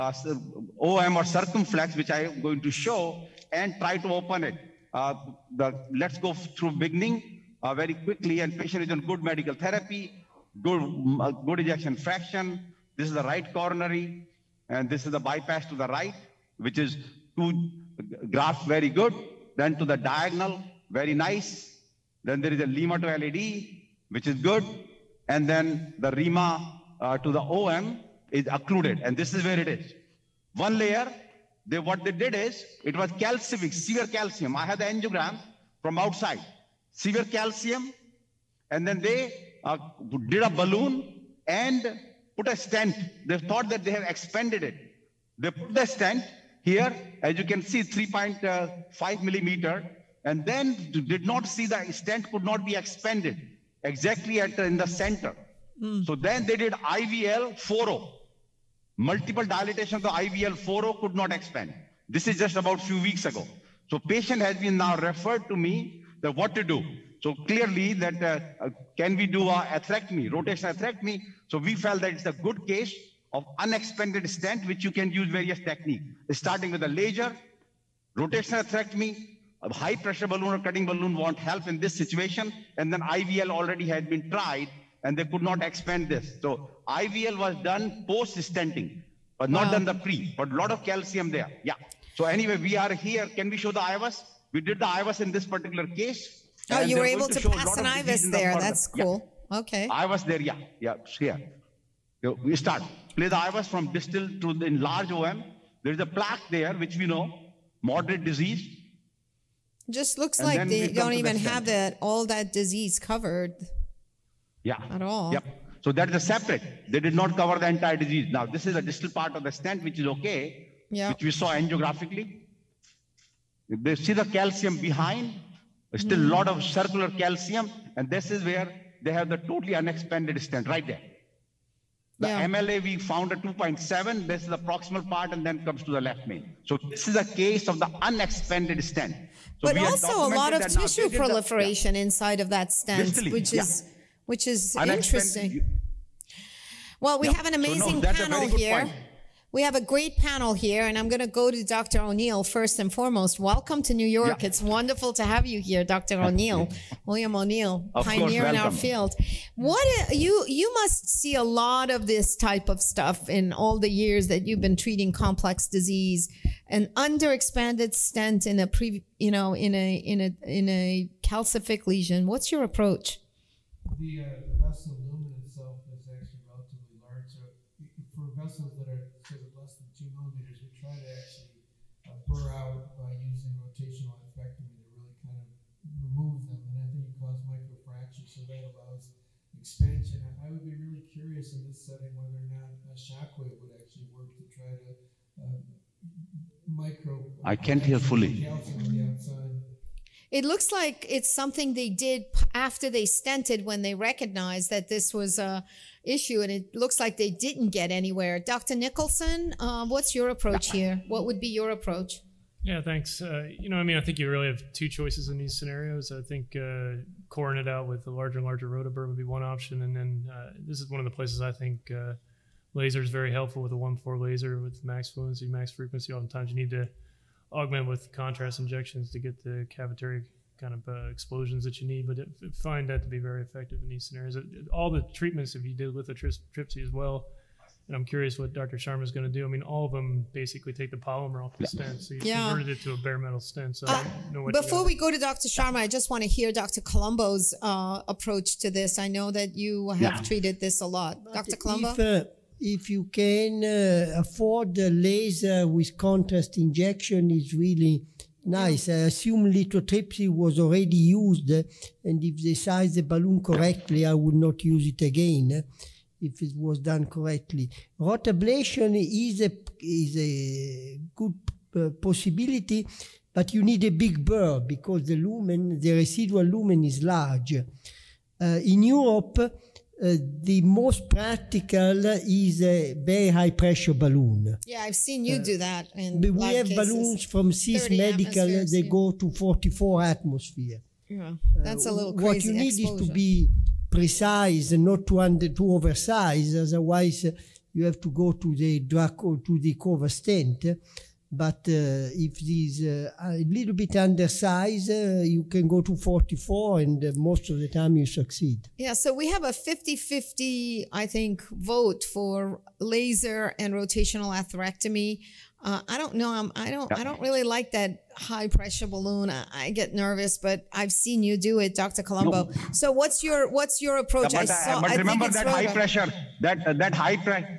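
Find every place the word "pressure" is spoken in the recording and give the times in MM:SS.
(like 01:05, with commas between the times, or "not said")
01:19, 04:43, 05:18, 05:25.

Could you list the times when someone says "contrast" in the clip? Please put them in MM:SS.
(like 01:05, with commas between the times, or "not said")
03:48, 04:15.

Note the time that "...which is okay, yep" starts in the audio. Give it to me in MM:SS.
01:59.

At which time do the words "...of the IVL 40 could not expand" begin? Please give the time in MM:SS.
00:59.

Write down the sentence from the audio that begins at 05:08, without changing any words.
Yeah, so we have a 50 50, I think, vote for laser and rotational atherectomy.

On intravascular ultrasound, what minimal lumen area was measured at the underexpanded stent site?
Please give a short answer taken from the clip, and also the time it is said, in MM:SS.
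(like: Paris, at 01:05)
2.7, at 02:13.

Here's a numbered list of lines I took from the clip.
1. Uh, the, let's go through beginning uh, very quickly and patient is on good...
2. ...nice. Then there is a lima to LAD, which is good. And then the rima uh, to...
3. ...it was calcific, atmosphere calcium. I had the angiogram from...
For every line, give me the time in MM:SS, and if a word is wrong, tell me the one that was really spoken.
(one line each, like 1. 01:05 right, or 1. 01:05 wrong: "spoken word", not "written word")
1. 00:04 right
2. 00:21 right
3. 00:32 wrong: "severe", not "atmosphere".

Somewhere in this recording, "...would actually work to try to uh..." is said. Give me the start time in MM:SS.
03:13.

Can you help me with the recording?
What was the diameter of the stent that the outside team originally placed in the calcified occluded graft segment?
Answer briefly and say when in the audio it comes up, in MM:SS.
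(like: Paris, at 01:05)
3.5 millimeter, at 00:47.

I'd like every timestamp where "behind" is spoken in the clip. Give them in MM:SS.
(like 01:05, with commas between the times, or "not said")
02:04.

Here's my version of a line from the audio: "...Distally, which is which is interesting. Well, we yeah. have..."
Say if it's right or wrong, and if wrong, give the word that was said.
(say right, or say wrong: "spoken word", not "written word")
right.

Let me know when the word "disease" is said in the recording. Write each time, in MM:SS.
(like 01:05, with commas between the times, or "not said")
01:48, 01:52, 01:57, 02:45.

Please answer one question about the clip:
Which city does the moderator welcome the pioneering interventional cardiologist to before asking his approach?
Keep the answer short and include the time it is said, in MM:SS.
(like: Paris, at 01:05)
New York, at 02:33.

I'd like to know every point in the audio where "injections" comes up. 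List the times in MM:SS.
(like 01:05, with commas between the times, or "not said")
03:48, 04:16.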